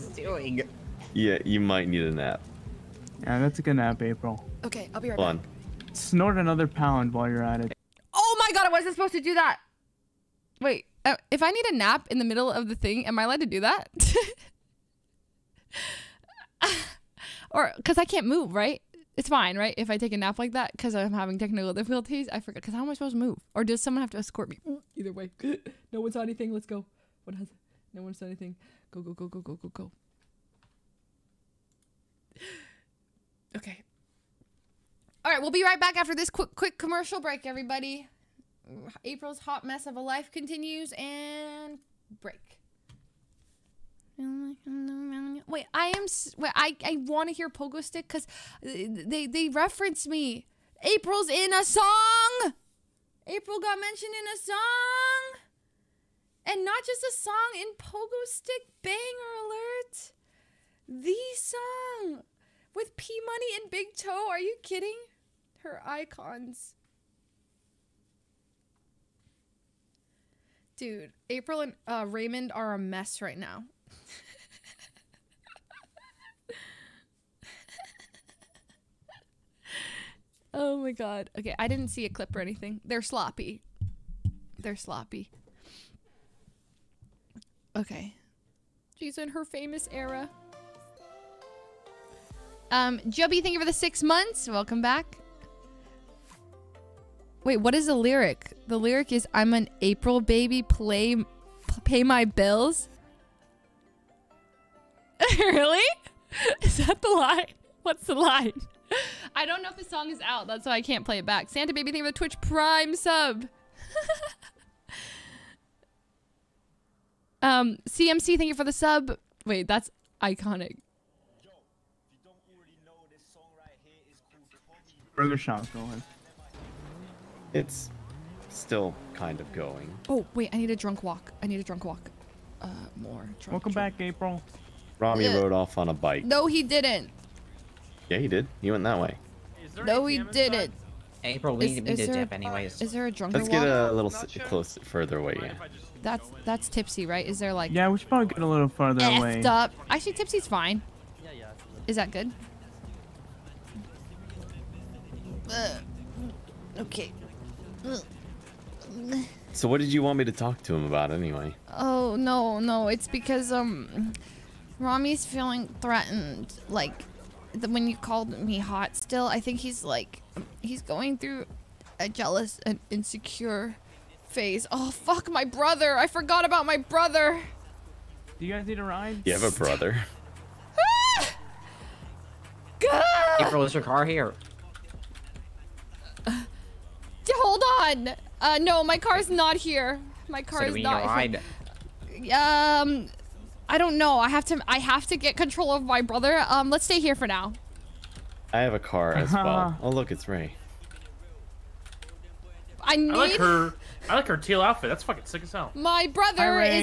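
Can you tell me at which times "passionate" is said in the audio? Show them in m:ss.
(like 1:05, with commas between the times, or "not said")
not said.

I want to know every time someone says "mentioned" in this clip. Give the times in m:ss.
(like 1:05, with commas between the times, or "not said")
0:53.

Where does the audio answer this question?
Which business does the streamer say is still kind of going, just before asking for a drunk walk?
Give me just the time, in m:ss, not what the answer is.
2:05.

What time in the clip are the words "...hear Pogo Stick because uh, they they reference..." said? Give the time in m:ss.
0:47.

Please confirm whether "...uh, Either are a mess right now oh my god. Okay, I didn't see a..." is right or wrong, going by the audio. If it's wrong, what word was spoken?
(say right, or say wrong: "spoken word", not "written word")
wrong: "Raymond", not "Either".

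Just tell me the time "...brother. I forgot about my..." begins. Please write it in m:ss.
2:55.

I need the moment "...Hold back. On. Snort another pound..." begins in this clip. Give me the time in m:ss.
0:05.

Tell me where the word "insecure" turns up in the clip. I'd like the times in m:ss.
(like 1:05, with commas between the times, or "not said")
2:52.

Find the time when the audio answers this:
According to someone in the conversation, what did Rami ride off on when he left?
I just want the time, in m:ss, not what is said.
2:15.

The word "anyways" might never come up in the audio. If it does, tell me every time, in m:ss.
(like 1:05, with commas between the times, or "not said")
2:22, 2:41.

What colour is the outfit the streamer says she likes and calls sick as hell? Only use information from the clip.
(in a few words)
Teal.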